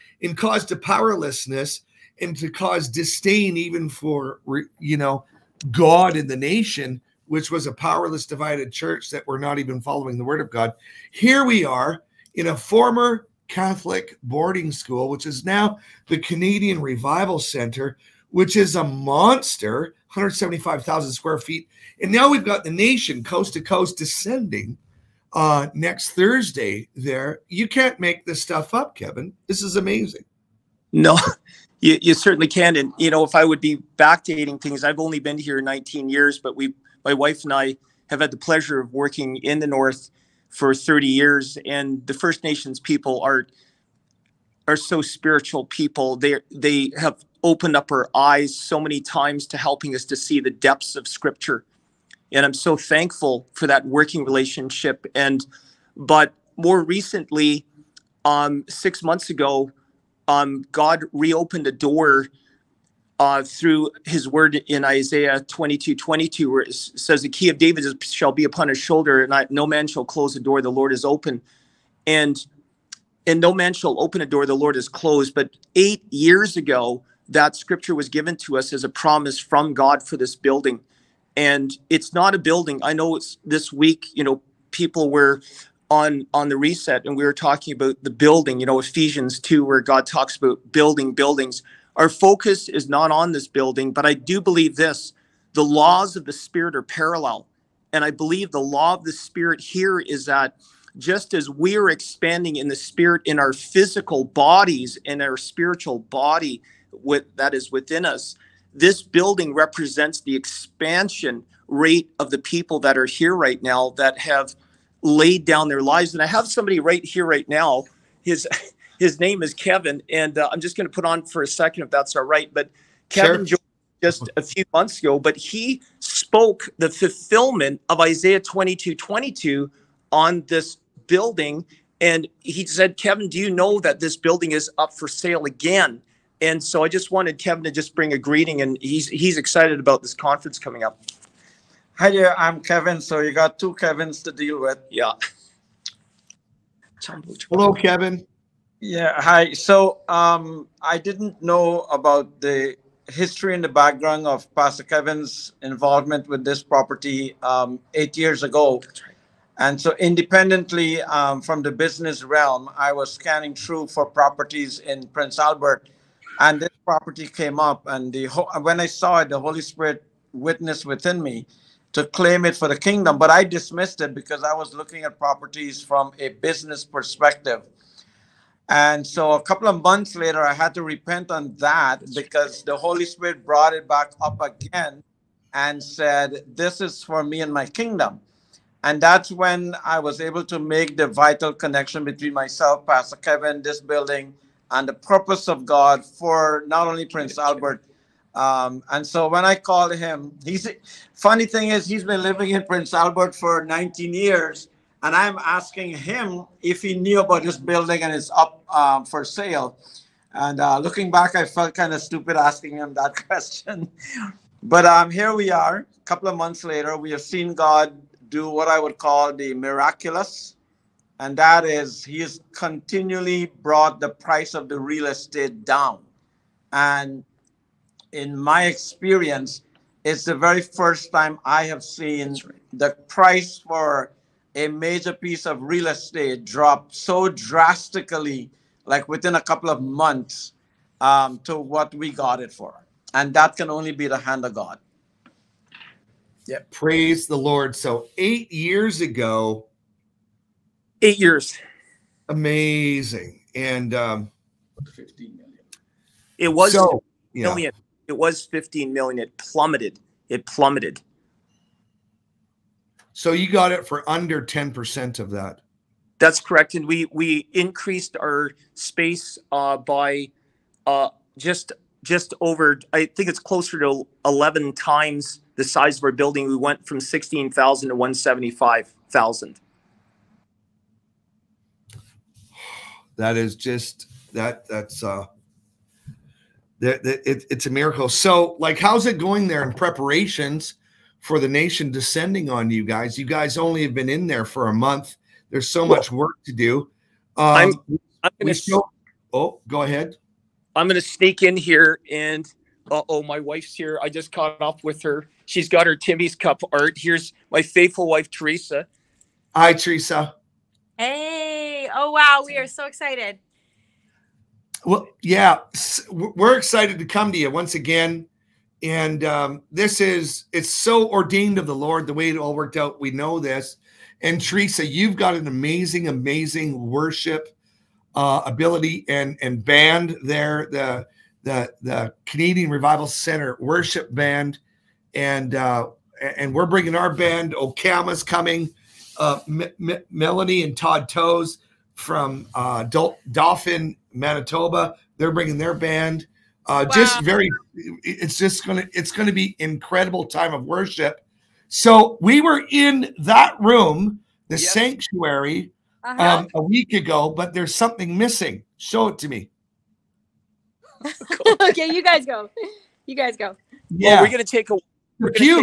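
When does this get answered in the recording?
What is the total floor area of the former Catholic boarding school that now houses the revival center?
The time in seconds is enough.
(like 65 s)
20 s.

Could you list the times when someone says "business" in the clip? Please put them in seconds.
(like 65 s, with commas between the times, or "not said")
161 s, 176 s.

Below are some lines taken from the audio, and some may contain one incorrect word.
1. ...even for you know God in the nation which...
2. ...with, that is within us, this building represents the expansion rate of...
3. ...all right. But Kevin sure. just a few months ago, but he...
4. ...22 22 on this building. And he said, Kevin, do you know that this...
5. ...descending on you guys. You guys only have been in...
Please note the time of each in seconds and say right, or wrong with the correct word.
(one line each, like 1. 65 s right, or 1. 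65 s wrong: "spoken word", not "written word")
1. 3 s right
2. 106 s right
3. 122 s right
4. 128 s right
5. 291 s right.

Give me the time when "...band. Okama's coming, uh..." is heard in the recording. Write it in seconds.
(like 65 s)
337 s.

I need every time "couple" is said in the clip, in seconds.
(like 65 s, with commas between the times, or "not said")
179 s, 216 s, 239 s.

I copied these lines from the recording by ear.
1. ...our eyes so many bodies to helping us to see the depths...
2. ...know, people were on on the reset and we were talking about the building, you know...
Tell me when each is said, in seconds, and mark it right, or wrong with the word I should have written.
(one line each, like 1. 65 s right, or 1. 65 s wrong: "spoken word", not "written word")
1. 47 s wrong: "times", not "bodies"
2. 84 s right.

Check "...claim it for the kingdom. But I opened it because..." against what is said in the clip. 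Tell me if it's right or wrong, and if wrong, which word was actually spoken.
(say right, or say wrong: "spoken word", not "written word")
wrong: "dismissed", not "opened".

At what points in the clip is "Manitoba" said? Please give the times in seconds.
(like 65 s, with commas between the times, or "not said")
344 s.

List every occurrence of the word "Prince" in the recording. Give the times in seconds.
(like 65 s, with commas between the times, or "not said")
165 s, 197 s, 202 s.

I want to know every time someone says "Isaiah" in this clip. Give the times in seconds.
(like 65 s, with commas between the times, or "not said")
64 s, 127 s.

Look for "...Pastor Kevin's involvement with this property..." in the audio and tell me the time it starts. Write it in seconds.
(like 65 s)
154 s.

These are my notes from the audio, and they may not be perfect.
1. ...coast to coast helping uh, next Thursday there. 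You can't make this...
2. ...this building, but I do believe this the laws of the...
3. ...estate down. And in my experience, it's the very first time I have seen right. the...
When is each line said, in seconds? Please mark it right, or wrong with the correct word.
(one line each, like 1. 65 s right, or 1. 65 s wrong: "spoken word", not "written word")
1. 23 s wrong: "descending", not "helping"
2. 93 s right
3. 225 s right.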